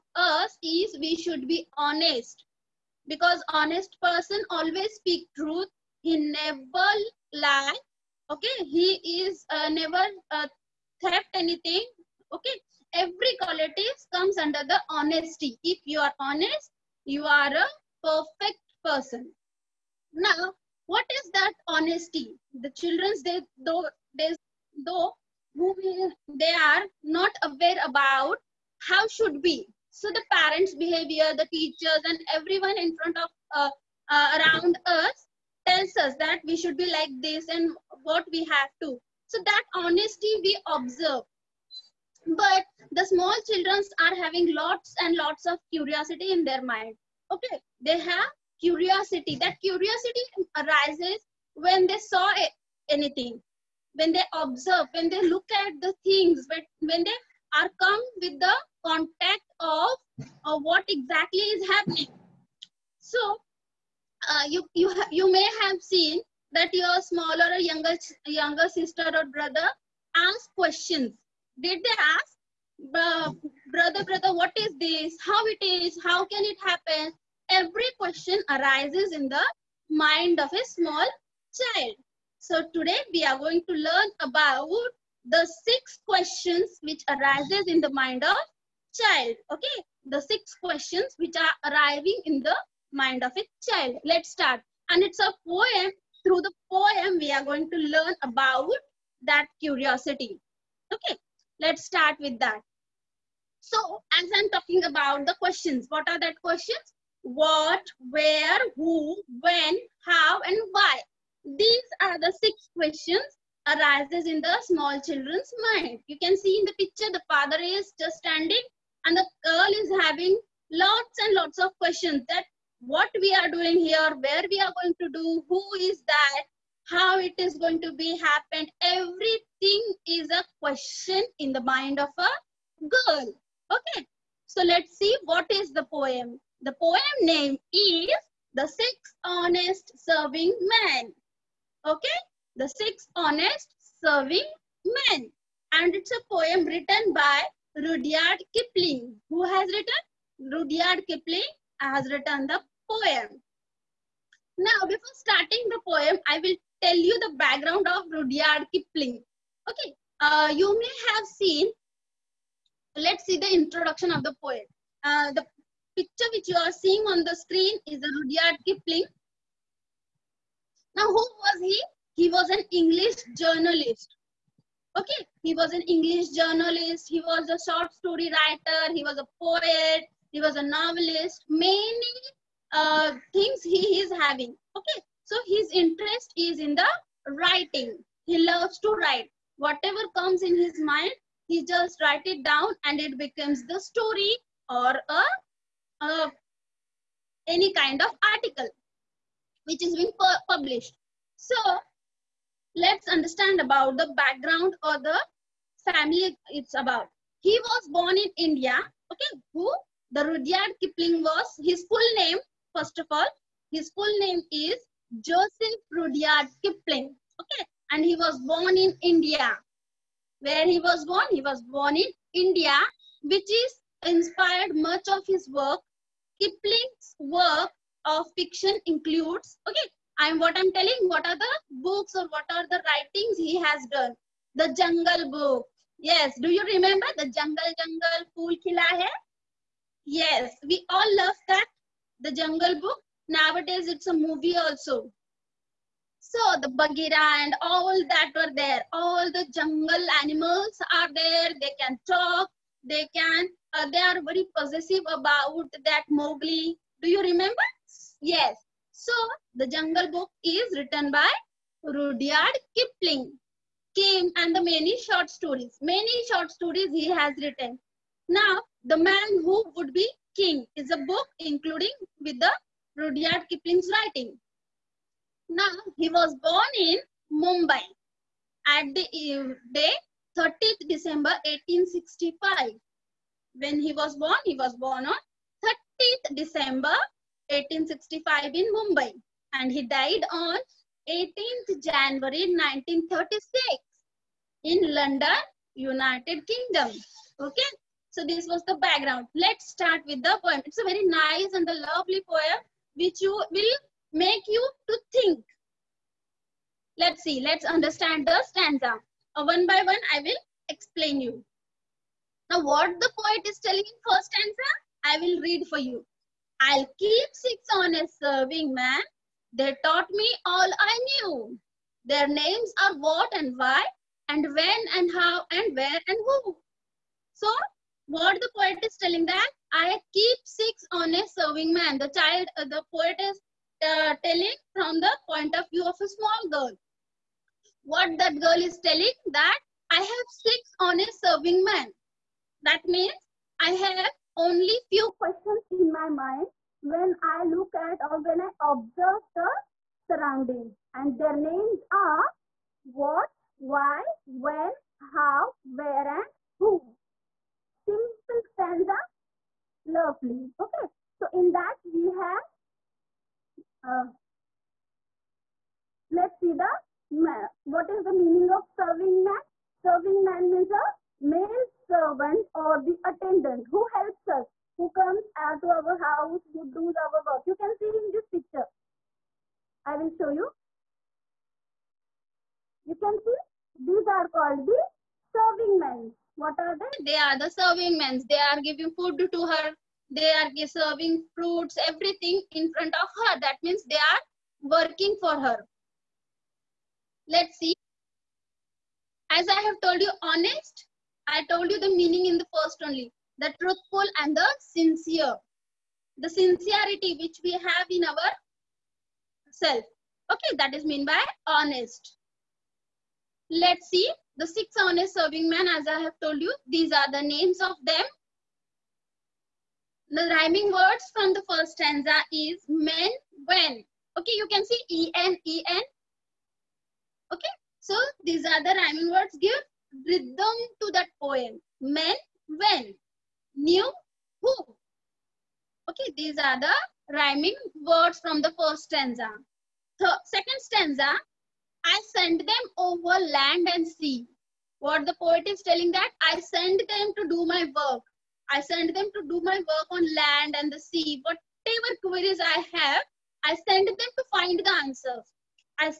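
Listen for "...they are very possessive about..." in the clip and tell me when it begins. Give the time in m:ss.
4:13.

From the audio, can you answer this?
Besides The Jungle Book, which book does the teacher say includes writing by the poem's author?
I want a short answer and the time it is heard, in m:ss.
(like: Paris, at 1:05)
The Man Who Would Be King, at 4:28.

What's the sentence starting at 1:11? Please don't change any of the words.
Did they ask, brother, brother, what is this?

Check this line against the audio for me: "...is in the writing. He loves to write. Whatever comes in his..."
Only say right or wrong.
right.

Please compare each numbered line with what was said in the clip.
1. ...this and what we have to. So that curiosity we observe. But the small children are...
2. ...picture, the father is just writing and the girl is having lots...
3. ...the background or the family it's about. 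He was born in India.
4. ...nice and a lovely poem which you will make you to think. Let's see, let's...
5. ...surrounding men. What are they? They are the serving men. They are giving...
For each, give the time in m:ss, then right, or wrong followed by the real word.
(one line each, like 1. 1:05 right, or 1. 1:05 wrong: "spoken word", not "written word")
1. 0:37 wrong: "honesty", not "curiosity"
2. 1:56 wrong: "standing", not "writing"
3. 3:23 right
4. 5:01 right
5. 6:25 wrong: "serving", not "surrounding".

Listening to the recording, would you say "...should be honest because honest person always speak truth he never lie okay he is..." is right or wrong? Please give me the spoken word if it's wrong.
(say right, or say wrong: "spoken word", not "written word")
right.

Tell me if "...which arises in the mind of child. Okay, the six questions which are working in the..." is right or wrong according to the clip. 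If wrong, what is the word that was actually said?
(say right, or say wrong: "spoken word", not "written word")
wrong: "arriving", not "working".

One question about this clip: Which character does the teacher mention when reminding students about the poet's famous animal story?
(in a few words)
Bagheera.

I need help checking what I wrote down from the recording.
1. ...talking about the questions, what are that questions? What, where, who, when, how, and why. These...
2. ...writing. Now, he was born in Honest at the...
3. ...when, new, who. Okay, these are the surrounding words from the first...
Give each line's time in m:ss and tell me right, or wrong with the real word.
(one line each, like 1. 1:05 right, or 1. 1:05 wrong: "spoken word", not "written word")
1. 1:44 right
2. 4:33 wrong: "Mumbai", not "Honest"
3. 7:12 wrong: "rhyming", not "surrounding".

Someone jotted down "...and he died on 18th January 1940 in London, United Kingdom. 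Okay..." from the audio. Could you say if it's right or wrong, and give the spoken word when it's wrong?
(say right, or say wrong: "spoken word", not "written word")
wrong: "1936", not "1940".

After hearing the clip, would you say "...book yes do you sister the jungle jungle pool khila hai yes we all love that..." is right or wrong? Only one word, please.
wrong.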